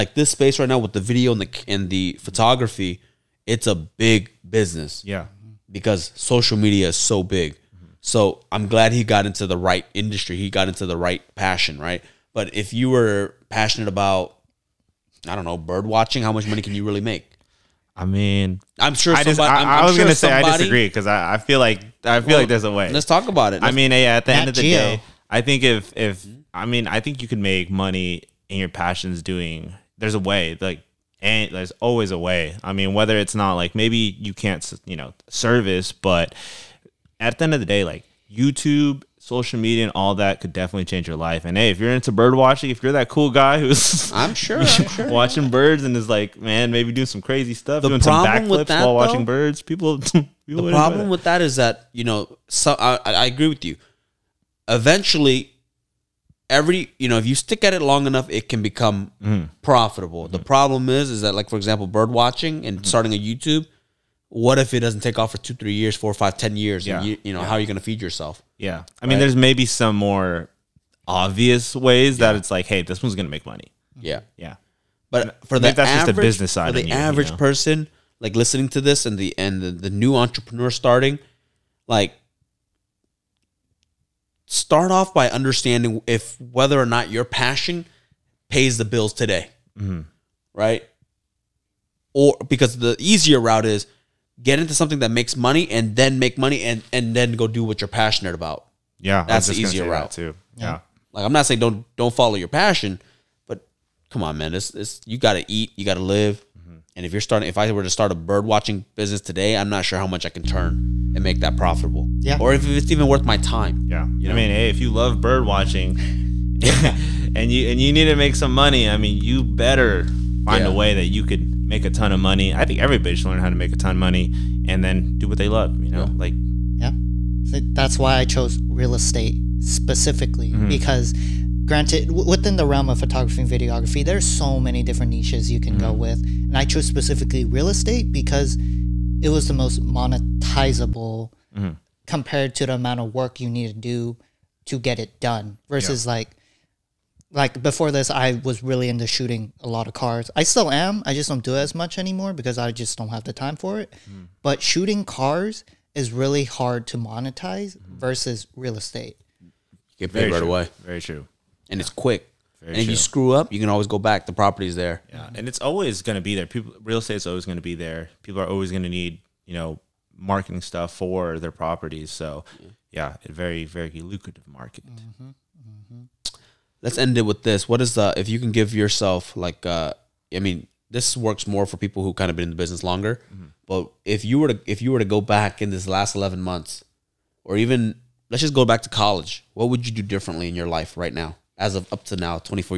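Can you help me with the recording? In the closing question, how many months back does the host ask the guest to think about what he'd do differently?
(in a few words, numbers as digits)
11.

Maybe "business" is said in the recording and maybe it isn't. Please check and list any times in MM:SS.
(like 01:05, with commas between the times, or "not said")
00:04, 01:16, 01:48, 03:02.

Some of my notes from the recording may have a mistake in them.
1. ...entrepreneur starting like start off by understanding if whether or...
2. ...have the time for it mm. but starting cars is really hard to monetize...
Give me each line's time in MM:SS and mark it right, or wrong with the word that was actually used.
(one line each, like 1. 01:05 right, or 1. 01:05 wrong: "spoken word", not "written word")
1. 01:20 right
2. 02:33 wrong: "shooting", not "starting".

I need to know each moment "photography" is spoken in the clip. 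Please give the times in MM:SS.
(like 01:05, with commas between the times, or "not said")
00:02, 02:12.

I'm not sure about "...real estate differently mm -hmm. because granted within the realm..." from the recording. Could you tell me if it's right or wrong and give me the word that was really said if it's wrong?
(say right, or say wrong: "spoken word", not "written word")
wrong: "specifically", not "differently".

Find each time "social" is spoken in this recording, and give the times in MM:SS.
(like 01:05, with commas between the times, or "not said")
00:06, 00:39.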